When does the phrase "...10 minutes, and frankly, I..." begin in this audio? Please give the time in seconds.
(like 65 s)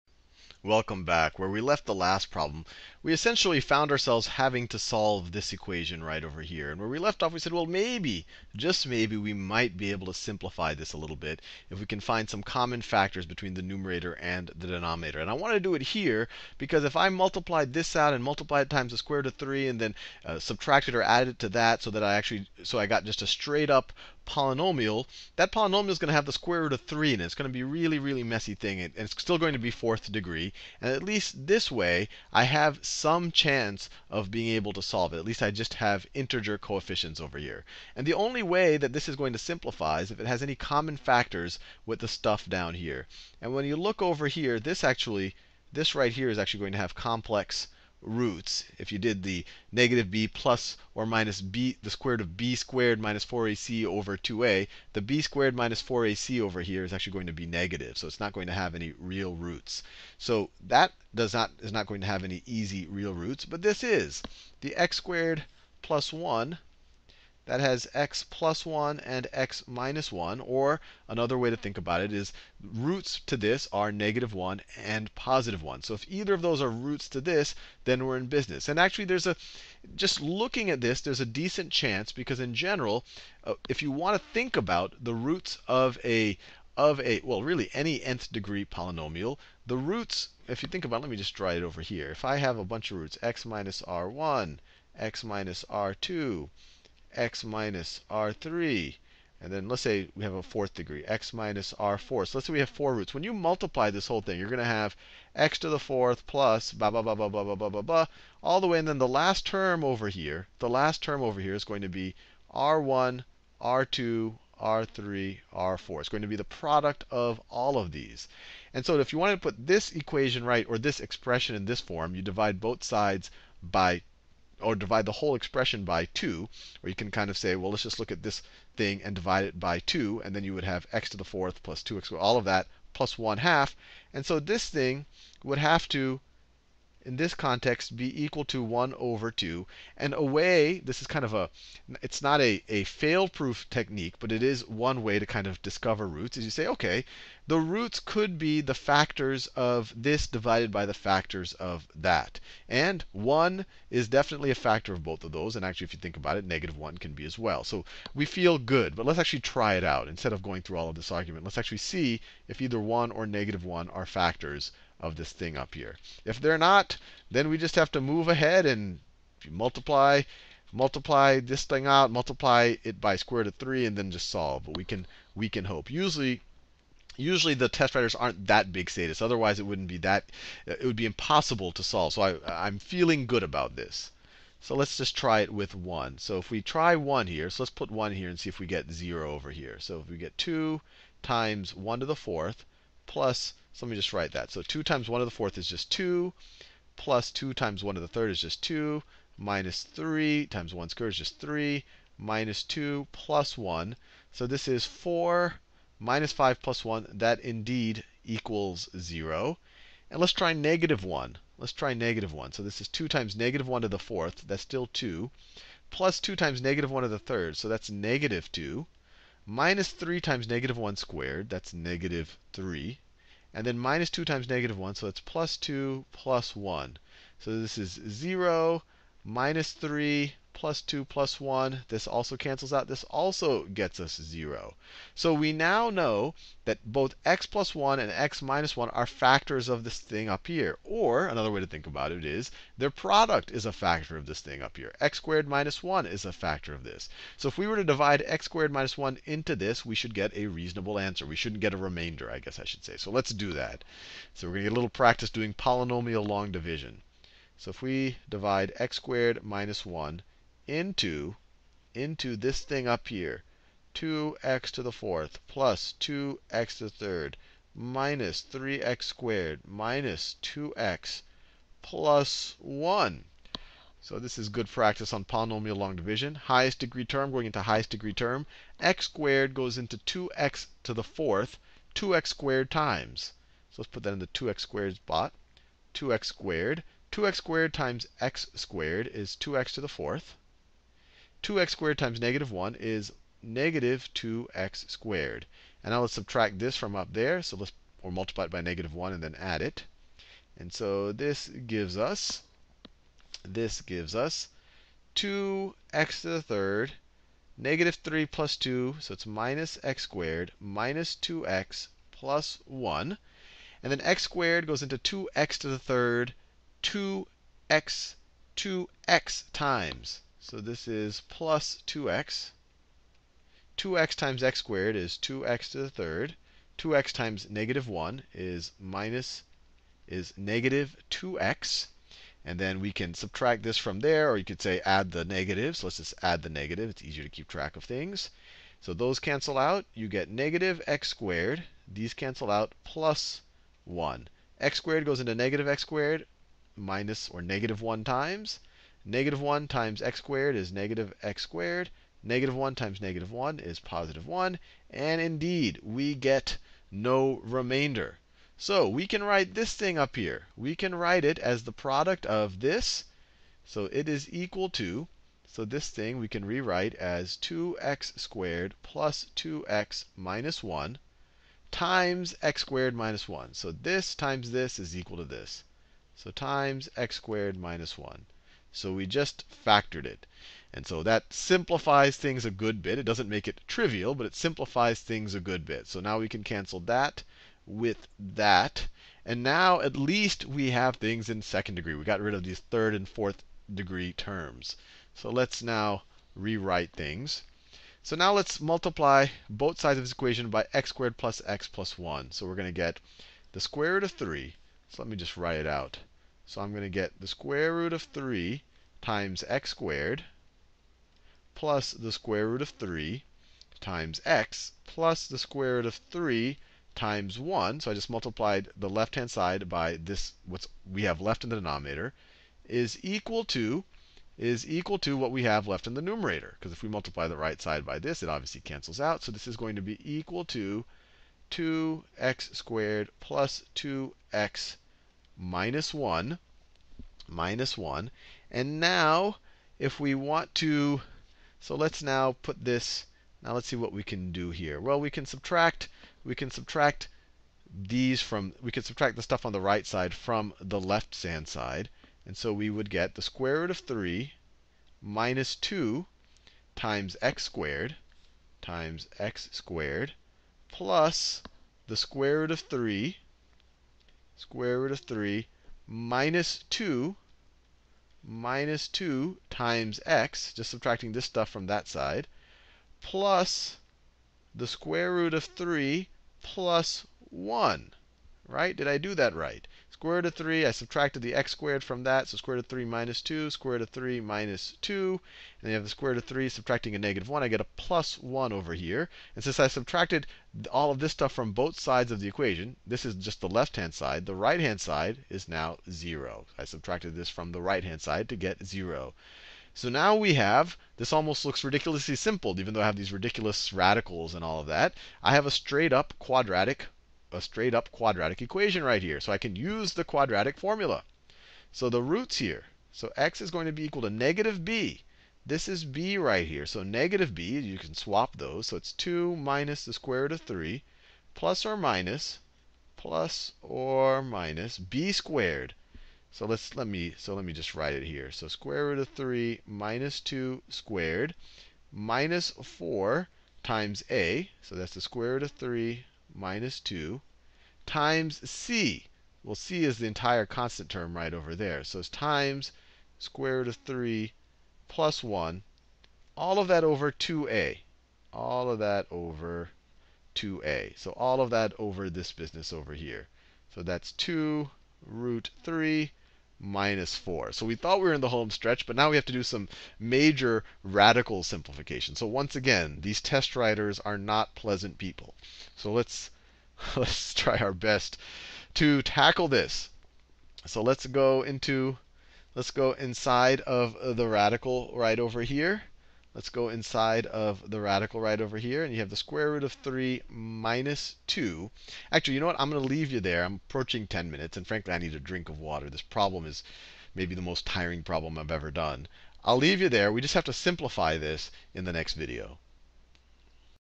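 584 s.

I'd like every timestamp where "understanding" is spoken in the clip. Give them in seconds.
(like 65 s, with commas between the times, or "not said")
not said.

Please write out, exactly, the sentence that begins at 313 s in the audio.
And then x squared goes into 2x to the third, 2x, 2x times.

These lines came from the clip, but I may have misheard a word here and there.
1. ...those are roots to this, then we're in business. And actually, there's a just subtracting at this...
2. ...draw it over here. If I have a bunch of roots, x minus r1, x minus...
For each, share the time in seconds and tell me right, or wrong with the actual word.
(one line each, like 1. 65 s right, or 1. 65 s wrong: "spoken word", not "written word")
1. 76 s wrong: "looking", not "subtracting"
2. 91 s right.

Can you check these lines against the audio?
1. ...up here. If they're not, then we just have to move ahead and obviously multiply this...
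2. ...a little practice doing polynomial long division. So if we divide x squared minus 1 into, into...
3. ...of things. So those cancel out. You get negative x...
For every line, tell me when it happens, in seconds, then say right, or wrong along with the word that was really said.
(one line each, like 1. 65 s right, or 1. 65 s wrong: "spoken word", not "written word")
1. 165 s wrong: "multiply", not "obviously"
2. 254 s right
3. 337 s right.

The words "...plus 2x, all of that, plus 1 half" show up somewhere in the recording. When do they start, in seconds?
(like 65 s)
131 s.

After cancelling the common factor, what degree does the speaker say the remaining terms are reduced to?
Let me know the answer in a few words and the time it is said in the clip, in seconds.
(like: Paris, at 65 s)
second degree, at 391 s.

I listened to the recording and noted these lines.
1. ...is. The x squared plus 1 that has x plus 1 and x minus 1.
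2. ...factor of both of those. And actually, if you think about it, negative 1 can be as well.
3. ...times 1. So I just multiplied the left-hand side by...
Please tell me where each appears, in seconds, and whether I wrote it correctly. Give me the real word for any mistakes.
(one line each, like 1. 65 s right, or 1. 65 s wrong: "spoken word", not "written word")
1. 63 s right
2. 154 s right
3. 416 s right.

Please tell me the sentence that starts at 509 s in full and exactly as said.
So I can use the quadratic formula.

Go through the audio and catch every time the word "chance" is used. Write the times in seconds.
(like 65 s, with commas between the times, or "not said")
33 s, 81 s.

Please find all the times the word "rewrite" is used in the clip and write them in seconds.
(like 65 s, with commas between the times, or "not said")
366 s, 396 s.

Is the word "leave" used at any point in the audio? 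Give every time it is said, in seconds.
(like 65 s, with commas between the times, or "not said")
582 s, 589 s.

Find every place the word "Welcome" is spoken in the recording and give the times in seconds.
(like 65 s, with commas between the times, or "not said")
0 s.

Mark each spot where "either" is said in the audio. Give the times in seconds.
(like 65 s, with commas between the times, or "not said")
76 s, 162 s.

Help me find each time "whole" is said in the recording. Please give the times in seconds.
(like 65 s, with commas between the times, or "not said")
104 s, 125 s.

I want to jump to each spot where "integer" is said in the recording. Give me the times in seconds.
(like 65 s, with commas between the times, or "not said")
36 s.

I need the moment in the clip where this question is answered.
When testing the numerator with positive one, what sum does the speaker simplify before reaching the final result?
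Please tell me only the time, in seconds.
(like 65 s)
204 s.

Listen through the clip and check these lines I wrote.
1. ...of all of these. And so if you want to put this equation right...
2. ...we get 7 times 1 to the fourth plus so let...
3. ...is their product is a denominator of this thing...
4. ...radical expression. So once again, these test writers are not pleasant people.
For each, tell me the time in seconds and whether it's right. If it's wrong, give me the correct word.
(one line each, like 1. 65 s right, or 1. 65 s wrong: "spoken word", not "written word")
1. 117 s right
2. 190 s wrong: "2", not "7"
3. 242 s wrong: "factor", not "denominator"
4. 560 s wrong: "simplification", not "expression".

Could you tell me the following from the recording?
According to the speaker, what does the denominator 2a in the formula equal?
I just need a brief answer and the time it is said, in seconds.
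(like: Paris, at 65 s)
2 root 3 minus 4, at 554 s.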